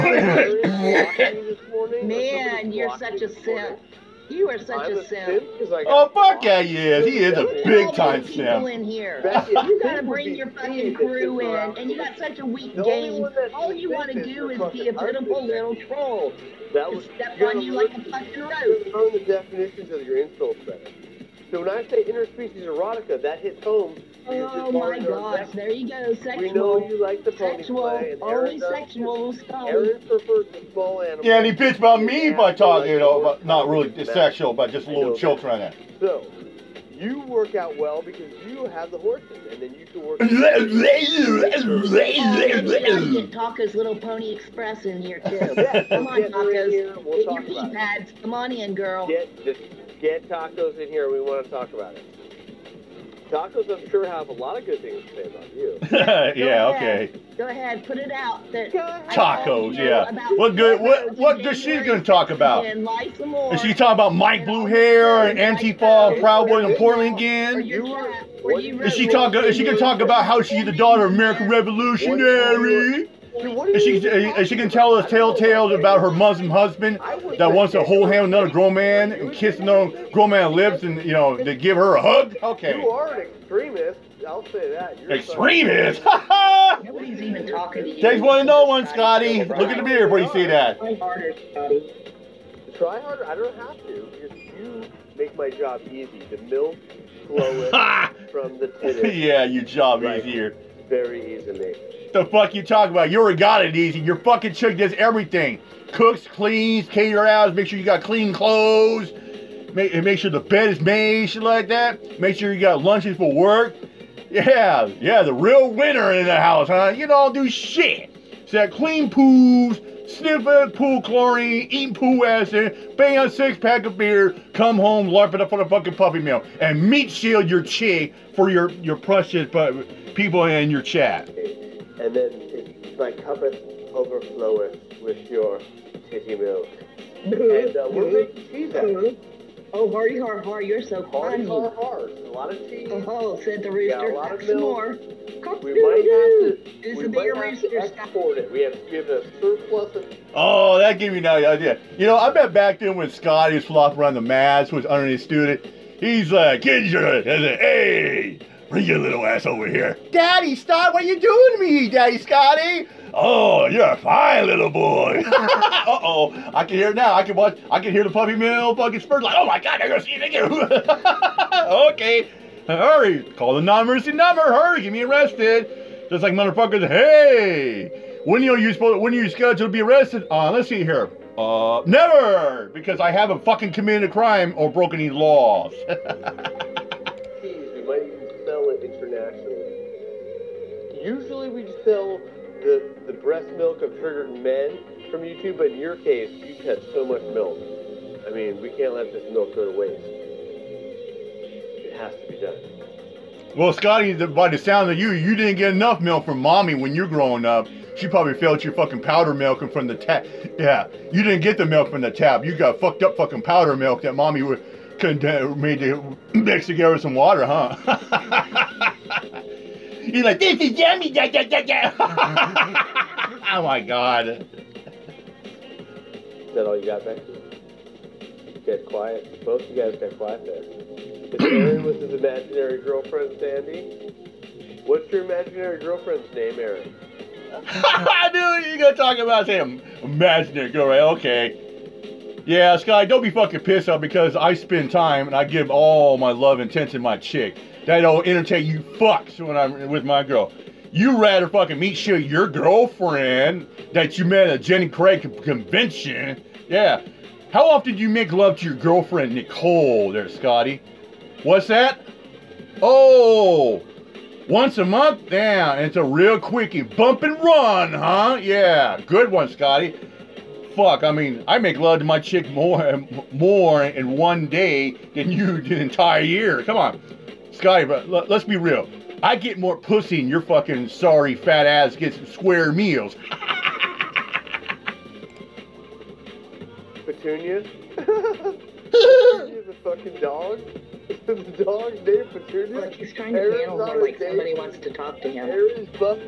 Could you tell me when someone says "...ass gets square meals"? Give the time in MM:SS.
04:41.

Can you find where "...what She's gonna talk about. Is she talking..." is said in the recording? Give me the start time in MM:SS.
01:01.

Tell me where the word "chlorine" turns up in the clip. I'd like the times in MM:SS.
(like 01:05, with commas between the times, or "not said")
02:01.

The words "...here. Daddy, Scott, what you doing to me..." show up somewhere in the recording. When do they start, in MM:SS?
02:39.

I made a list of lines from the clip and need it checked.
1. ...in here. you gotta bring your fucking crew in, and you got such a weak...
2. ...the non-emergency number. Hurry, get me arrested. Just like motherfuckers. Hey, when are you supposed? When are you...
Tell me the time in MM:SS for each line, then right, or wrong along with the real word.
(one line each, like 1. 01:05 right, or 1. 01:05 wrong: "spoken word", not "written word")
1. 00:08 right
2. 02:53 right.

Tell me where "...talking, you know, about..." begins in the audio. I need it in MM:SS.
00:32.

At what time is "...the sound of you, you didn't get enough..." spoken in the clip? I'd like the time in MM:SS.
03:24.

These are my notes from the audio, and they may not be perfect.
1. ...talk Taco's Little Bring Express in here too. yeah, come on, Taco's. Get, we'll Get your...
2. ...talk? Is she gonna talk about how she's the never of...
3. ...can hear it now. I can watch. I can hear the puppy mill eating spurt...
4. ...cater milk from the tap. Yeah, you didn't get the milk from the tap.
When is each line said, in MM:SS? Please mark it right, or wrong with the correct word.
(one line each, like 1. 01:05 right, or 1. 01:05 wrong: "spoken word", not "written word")
1. 00:43 wrong: "Pony", not "Bring"
2. 01:09 wrong: "daughter", not "never"
3. 02:46 wrong: "fucking", not "eating"
4. 03:28 wrong: "powder", not "cater".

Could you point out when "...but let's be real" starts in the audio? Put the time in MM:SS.
04:37.